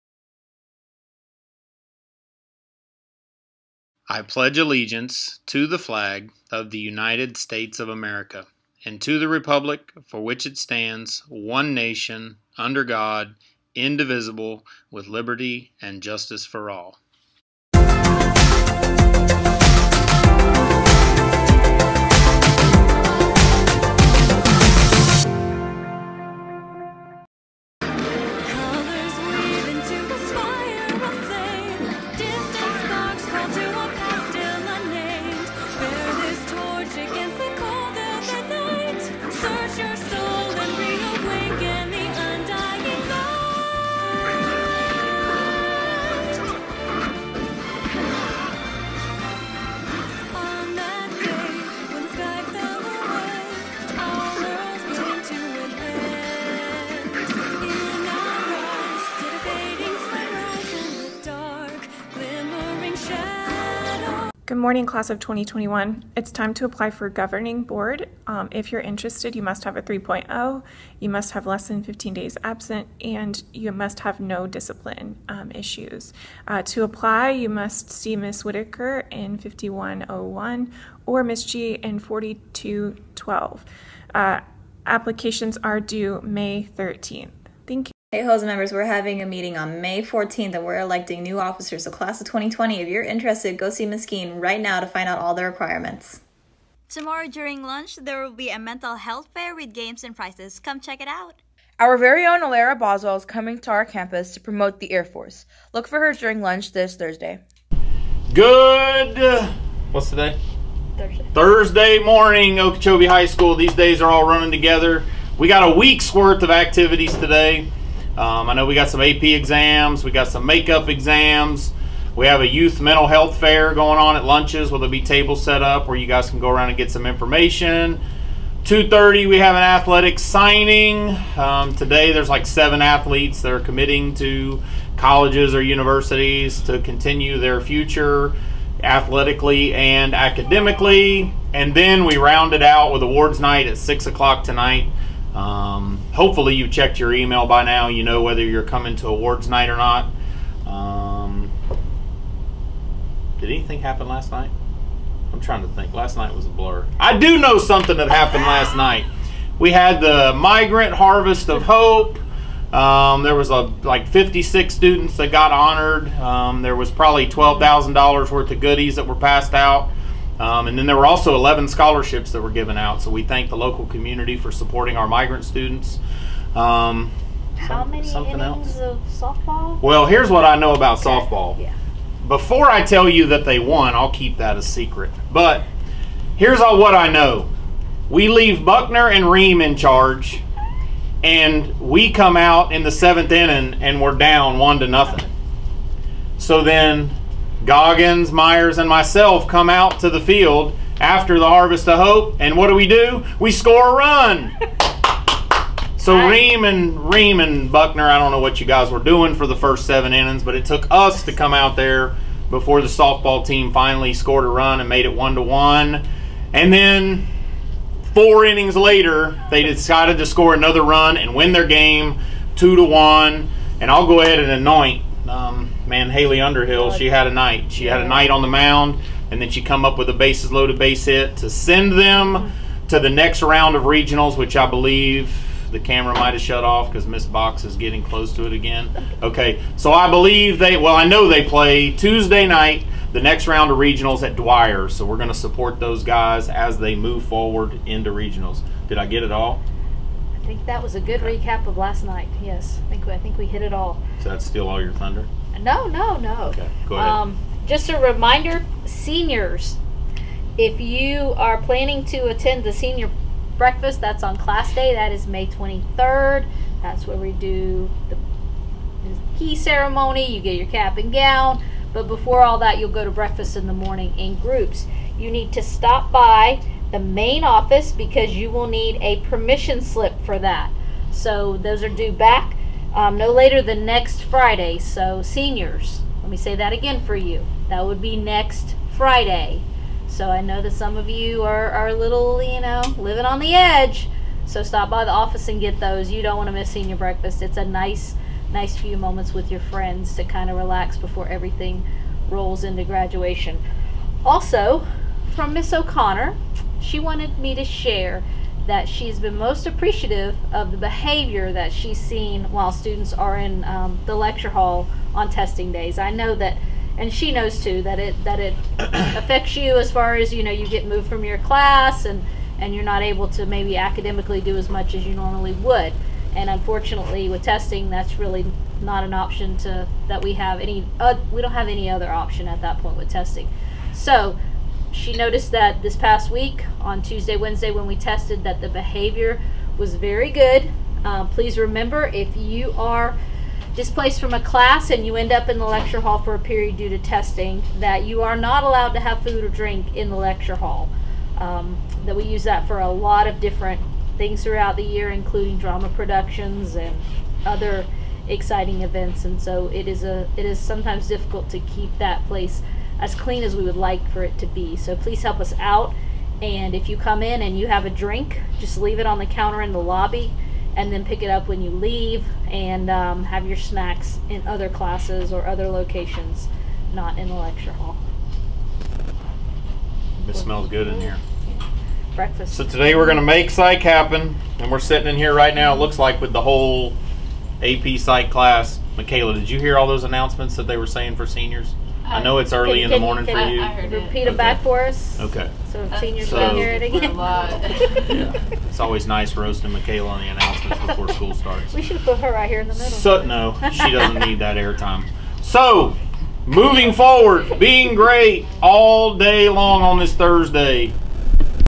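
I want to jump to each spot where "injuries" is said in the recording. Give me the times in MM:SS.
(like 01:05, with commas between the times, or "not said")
not said.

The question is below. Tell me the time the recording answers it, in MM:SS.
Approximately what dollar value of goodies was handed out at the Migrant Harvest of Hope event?
02:47.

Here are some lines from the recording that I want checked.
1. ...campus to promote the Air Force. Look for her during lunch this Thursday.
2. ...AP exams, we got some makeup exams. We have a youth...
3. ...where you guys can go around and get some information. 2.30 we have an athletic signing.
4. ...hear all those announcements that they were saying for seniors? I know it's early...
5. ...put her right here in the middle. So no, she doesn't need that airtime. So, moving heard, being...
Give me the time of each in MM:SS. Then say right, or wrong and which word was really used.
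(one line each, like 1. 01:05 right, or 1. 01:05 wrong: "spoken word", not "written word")
1. 01:43 right
2. 01:59 right
3. 02:05 right
4. 06:29 right
5. 06:41 wrong: "forward", not "heard".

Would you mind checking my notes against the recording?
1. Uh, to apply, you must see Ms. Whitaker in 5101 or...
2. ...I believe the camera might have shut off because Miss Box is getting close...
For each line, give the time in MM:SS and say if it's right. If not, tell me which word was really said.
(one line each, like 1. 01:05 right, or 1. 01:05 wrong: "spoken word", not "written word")
1. 01:16 right
2. 03:54 right.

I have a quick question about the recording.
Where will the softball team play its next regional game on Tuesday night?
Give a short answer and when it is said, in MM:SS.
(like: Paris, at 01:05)
Dwyer, at 04:04.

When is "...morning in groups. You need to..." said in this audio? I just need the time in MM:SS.
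04:33.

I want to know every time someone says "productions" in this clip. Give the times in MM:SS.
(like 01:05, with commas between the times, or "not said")
05:55.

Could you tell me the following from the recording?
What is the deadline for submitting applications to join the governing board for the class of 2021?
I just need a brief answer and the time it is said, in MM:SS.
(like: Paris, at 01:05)
May 13th, at 01:26.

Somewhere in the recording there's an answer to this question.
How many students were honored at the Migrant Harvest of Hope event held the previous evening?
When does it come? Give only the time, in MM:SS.
02:44.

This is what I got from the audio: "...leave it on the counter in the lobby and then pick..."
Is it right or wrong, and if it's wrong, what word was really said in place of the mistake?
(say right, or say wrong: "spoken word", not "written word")
right.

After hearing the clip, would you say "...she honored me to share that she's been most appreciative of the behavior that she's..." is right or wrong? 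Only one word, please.
wrong.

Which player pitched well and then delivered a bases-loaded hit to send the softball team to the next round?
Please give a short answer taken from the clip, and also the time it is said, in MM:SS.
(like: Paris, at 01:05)
Haley Underhill, at 03:46.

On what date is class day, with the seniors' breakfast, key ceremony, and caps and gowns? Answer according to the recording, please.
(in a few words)
May 23rd.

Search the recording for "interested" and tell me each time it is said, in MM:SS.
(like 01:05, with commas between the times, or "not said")
01:08, 01:33.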